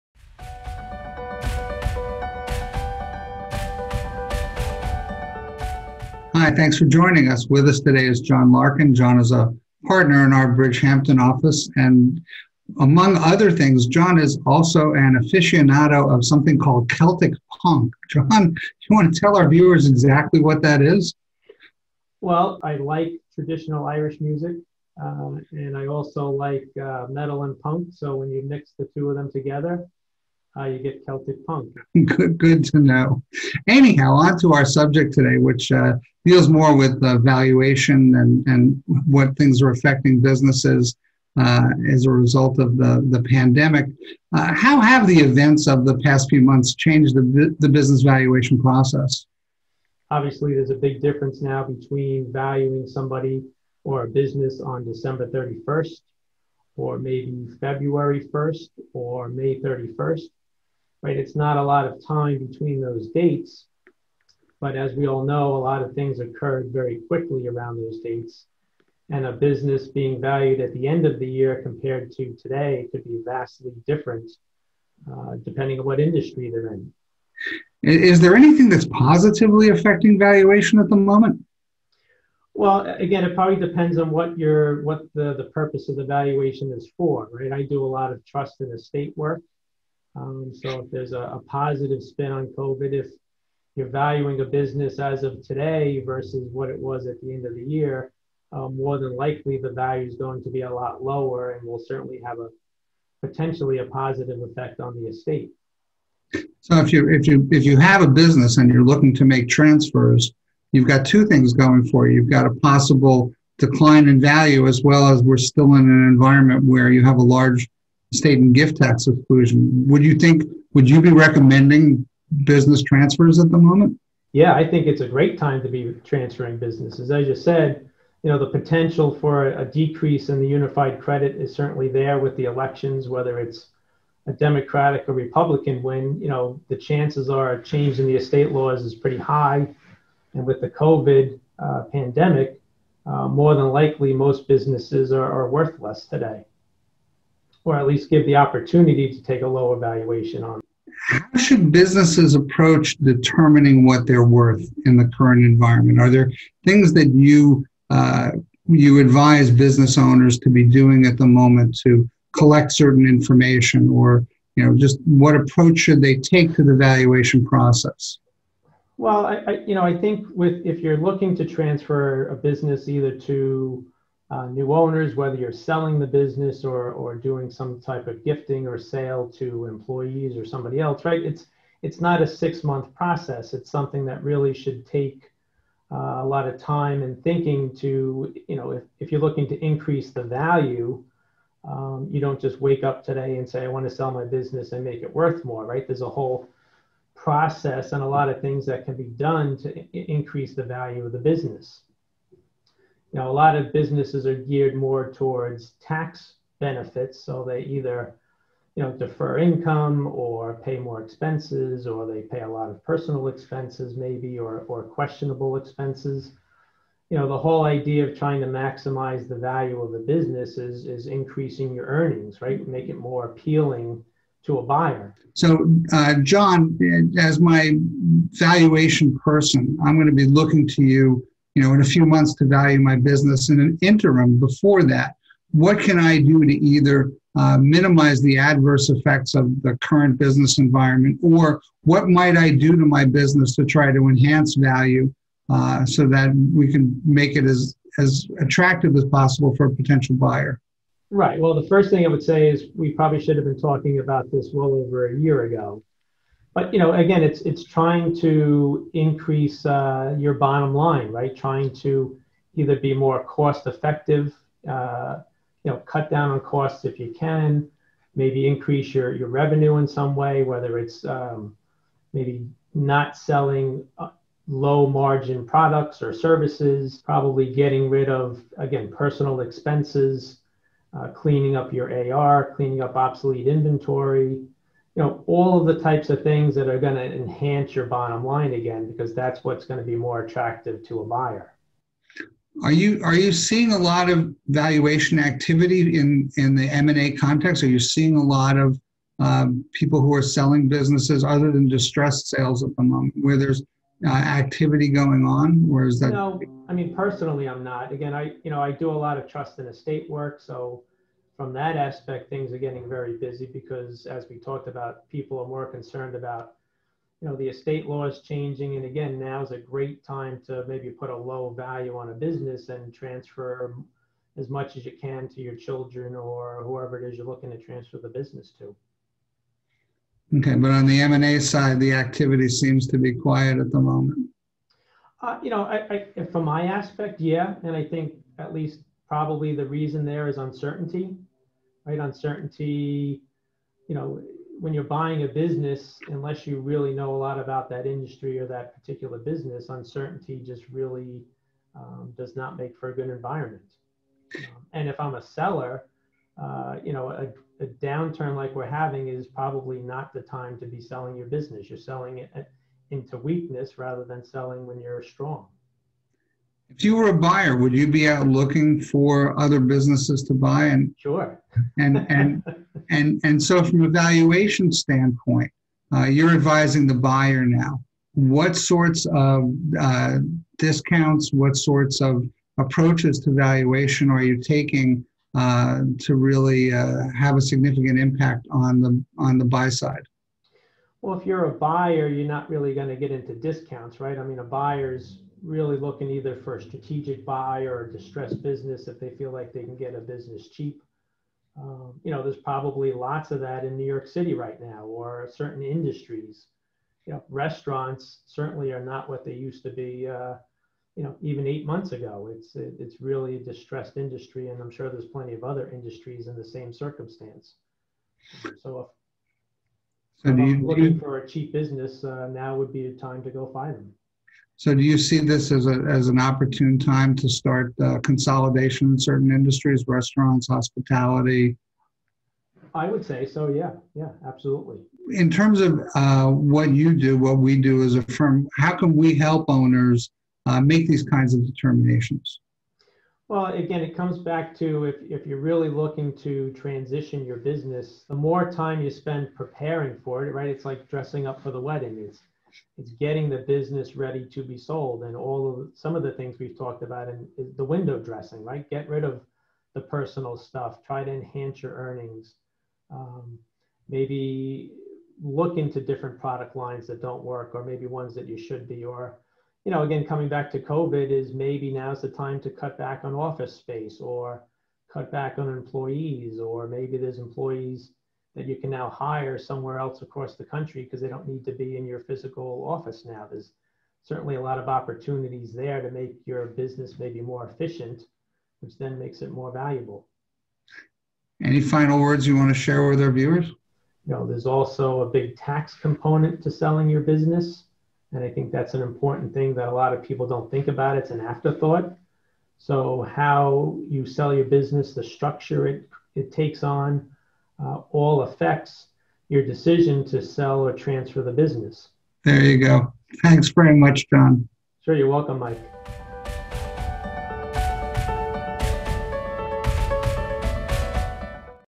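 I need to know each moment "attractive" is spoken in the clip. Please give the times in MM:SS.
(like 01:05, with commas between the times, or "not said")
04:08, 04:50.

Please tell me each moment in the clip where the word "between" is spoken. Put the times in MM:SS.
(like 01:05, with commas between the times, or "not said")
00:51, 01:02.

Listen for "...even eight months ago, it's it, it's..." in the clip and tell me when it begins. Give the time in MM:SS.
06:51.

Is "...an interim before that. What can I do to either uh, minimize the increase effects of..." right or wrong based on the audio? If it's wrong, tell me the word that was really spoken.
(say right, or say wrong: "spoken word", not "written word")
wrong: "adverse", not "increase".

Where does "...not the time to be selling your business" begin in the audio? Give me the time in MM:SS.
05:59.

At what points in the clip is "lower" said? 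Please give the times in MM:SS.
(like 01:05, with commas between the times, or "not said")
01:41, 02:29.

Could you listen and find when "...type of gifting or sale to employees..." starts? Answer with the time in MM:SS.
02:57.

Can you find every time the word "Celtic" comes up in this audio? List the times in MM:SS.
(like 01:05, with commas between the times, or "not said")
00:16, 00:31.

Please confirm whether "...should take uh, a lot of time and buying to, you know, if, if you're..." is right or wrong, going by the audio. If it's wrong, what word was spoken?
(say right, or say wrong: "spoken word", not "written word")
wrong: "thinking", not "buying".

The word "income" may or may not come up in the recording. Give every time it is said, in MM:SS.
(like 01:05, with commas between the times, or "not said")
03:29.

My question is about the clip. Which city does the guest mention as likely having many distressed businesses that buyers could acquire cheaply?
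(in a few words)
New York City.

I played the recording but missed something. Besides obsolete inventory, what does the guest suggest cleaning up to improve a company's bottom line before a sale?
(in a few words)
AR.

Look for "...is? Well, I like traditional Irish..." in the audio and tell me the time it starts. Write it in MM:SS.
00:20.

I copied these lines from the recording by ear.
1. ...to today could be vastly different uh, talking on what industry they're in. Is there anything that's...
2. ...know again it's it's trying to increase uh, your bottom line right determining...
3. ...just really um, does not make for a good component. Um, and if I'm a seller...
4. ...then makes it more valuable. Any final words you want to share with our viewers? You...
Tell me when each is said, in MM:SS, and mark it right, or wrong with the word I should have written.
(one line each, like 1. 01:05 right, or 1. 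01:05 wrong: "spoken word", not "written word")
1. 01:12 wrong: "depending", not "talking"
2. 04:16 wrong: "trying", not "determining"
3. 05:50 wrong: "environment", not "component"
4. 08:08 right.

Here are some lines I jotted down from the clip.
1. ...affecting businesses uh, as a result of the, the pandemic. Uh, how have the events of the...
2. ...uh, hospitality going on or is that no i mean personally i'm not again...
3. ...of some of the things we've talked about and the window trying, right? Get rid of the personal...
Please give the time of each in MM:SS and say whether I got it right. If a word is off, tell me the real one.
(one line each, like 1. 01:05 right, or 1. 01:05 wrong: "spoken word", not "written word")
1. 00:39 right
2. 05:04 wrong: "activity", not "hospitality"
3. 07:35 wrong: "dressing", not "trying".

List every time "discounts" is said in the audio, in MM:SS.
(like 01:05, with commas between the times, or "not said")
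06:20, 06:33.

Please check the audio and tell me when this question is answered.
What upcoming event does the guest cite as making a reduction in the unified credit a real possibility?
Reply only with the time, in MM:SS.
02:12.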